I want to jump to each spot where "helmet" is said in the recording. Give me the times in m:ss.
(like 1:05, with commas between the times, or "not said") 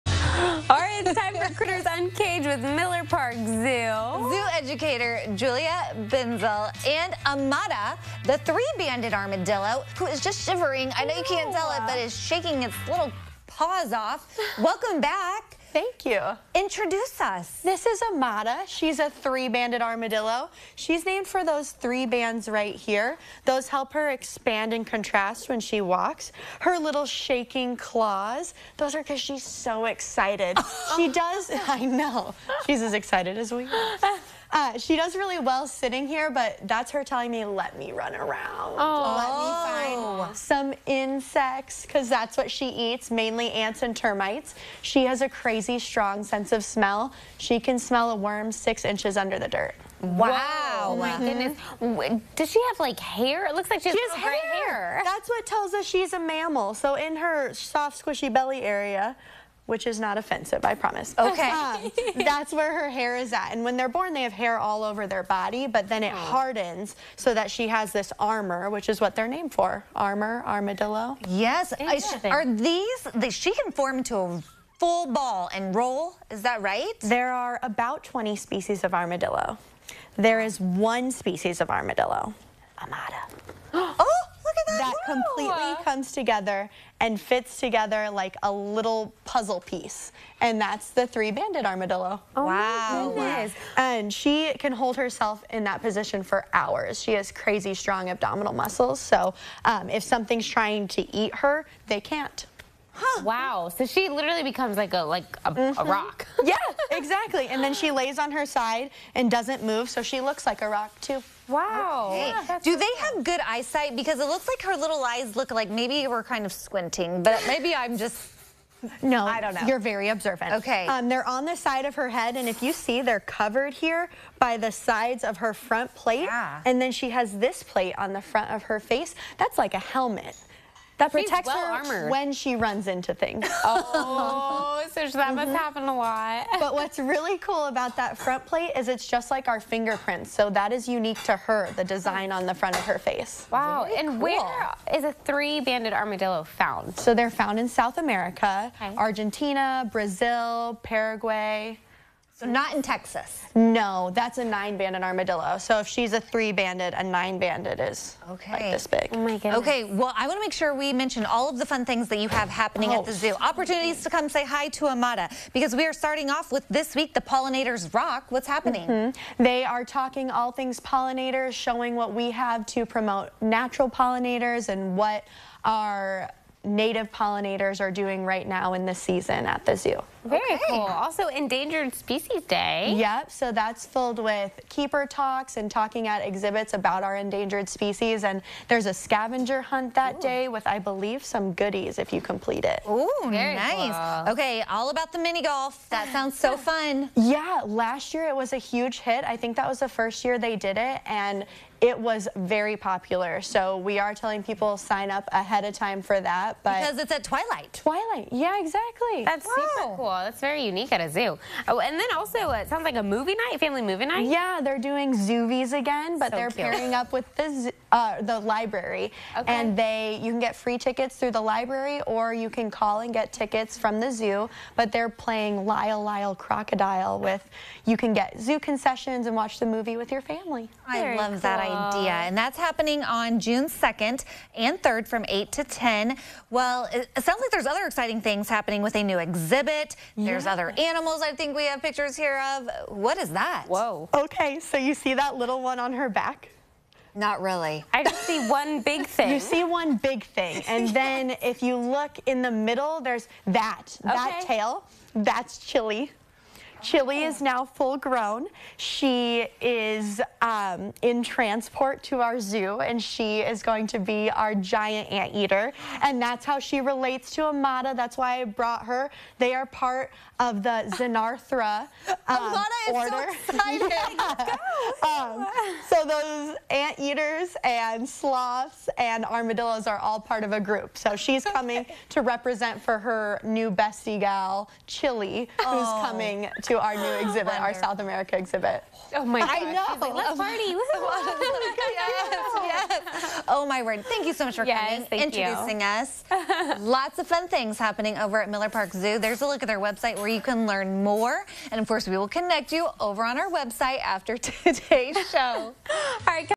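2:09.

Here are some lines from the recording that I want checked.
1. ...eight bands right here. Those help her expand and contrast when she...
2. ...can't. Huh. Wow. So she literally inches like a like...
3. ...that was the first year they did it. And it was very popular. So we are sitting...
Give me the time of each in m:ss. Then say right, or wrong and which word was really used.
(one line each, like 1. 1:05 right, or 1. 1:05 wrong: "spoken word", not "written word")
1. 0:21 wrong: "three", not "eight"
2. 1:42 wrong: "becomes", not "inches"
3. 3:19 wrong: "telling", not "sitting".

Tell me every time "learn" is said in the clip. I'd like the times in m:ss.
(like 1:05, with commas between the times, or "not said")
5:00.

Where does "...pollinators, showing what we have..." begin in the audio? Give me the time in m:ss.
2:50.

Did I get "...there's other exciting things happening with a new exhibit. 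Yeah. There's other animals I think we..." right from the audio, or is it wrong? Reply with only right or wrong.
right.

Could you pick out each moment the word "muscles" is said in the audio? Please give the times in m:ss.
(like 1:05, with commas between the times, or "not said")
1:38.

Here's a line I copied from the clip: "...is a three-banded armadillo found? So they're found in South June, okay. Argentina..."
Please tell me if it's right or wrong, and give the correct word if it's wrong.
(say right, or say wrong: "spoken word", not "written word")
wrong: "America", not "June".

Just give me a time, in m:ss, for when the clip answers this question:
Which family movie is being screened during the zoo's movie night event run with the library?
3:45.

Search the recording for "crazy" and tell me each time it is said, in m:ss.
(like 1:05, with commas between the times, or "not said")
0:45, 1:37.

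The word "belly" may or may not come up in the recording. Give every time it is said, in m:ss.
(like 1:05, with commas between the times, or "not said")
0:58.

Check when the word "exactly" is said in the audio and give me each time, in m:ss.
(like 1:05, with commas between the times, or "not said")
1:47, 3:28.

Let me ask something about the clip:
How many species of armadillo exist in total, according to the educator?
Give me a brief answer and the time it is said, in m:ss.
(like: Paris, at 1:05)
About 20, at 1:17.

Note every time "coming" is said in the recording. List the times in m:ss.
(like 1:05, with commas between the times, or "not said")
4:41, 4:46, 4:55.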